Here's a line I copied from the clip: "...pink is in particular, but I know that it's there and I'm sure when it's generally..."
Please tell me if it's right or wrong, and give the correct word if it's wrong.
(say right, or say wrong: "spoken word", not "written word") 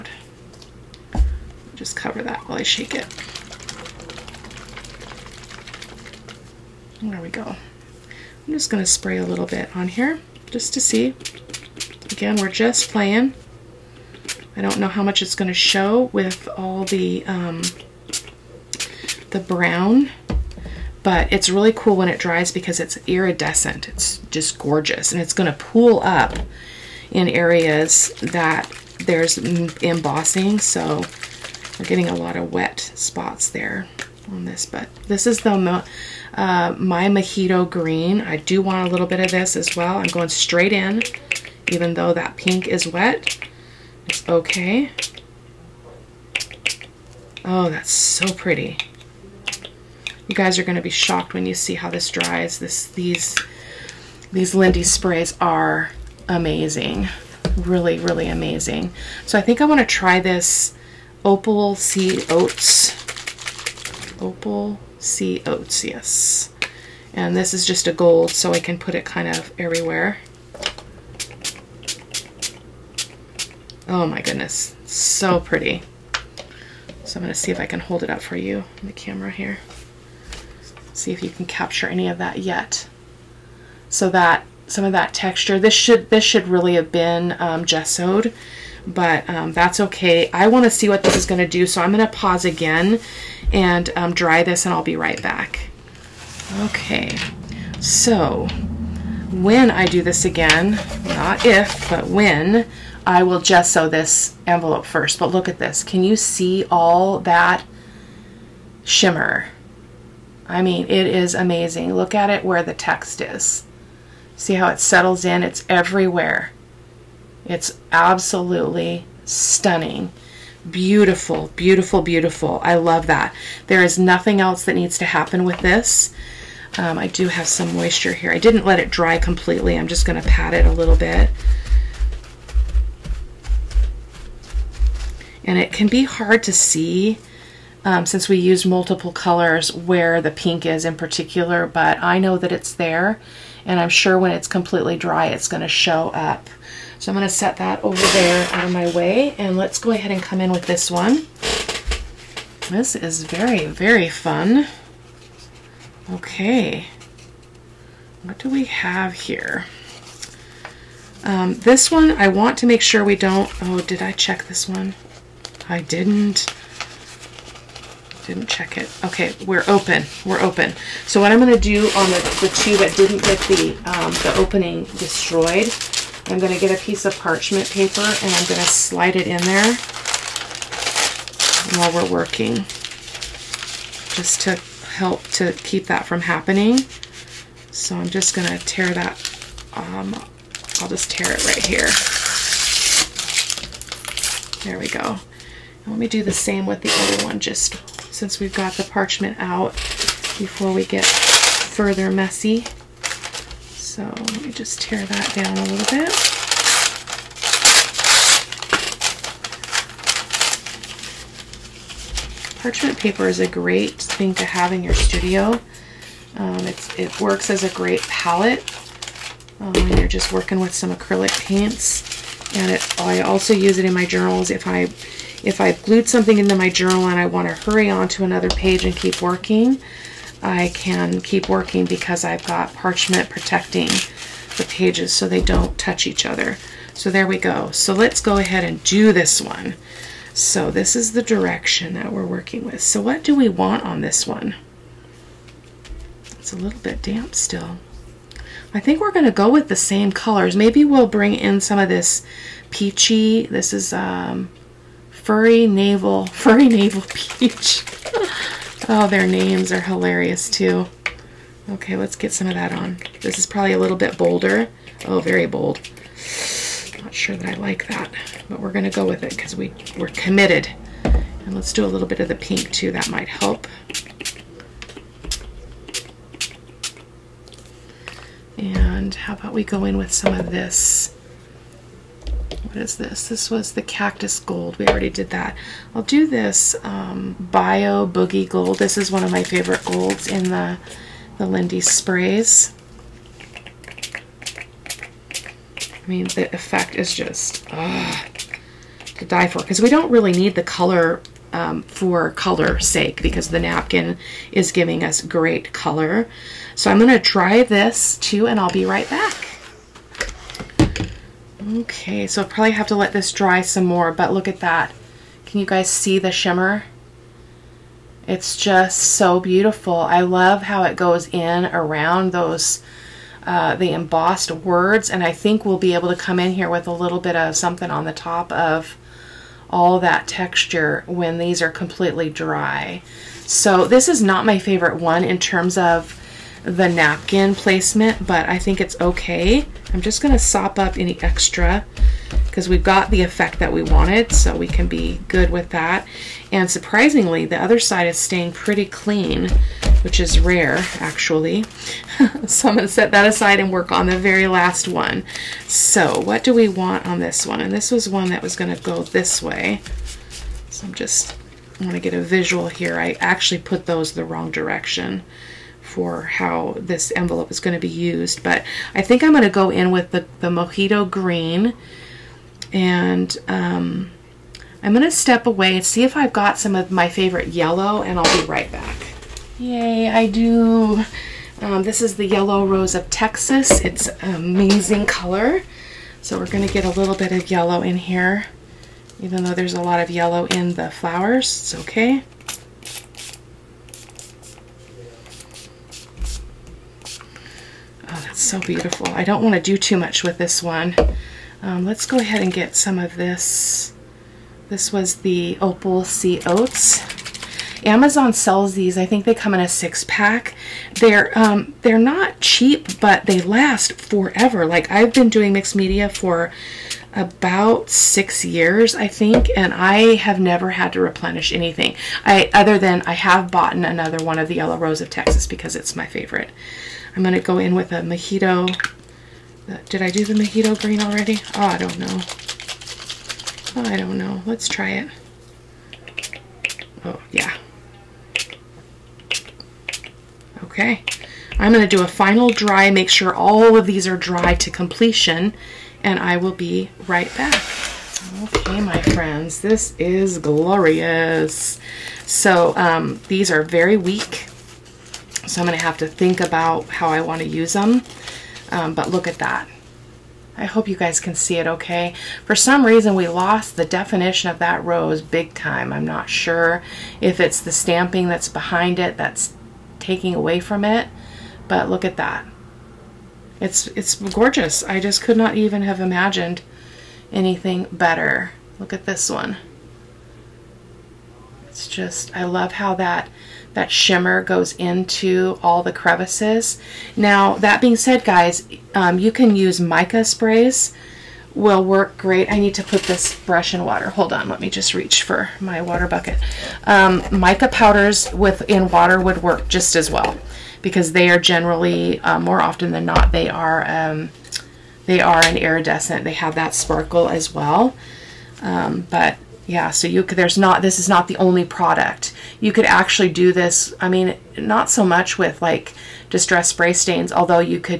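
wrong: "completely", not "generally".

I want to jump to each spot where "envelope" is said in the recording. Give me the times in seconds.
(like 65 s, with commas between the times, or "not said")
104 s, 367 s.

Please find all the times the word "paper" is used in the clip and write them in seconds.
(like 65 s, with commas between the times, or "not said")
177 s, 212 s.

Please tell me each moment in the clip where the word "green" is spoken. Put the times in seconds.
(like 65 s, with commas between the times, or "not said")
37 s, 371 s, 430 s.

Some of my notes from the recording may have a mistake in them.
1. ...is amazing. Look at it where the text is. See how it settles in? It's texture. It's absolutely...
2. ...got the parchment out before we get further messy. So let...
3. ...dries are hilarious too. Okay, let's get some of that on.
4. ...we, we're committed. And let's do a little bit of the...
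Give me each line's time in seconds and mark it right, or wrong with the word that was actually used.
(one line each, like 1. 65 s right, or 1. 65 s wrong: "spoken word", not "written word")
1. 111 s wrong: "everywhere", not "texture"
2. 198 s right
3. 259 s wrong: "names", not "dries"
4. 269 s right.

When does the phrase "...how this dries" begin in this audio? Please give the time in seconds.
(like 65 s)
51 s.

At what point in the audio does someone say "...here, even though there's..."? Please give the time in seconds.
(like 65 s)
387 s.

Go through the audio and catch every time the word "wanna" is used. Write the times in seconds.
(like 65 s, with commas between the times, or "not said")
59 s, 361 s.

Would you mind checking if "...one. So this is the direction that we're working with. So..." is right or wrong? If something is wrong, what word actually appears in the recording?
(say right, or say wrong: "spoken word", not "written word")
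right.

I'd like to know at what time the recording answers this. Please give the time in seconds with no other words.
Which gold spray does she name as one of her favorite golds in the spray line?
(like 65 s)
287 s.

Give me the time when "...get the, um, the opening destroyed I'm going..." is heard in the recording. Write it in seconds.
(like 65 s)
173 s.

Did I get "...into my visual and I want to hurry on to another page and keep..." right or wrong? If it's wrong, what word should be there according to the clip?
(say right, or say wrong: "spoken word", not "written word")
wrong: "journal", not "visual".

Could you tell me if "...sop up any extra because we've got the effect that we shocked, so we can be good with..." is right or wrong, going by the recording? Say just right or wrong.
wrong.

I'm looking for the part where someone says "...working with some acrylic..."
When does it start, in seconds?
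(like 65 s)
220 s.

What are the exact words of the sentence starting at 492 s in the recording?
I need to put this brush in water.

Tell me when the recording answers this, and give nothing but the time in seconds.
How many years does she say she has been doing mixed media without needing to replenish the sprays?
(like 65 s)
417 s.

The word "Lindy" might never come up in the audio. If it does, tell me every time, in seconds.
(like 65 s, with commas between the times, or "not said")
54 s, 291 s.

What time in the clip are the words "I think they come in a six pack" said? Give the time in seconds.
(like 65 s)
408 s.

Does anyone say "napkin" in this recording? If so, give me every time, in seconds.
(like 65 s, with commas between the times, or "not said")
303 s, 336 s.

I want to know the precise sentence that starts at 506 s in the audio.
They have that sparkle as well.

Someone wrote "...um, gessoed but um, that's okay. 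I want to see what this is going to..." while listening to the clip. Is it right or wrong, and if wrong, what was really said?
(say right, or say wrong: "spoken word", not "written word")
right.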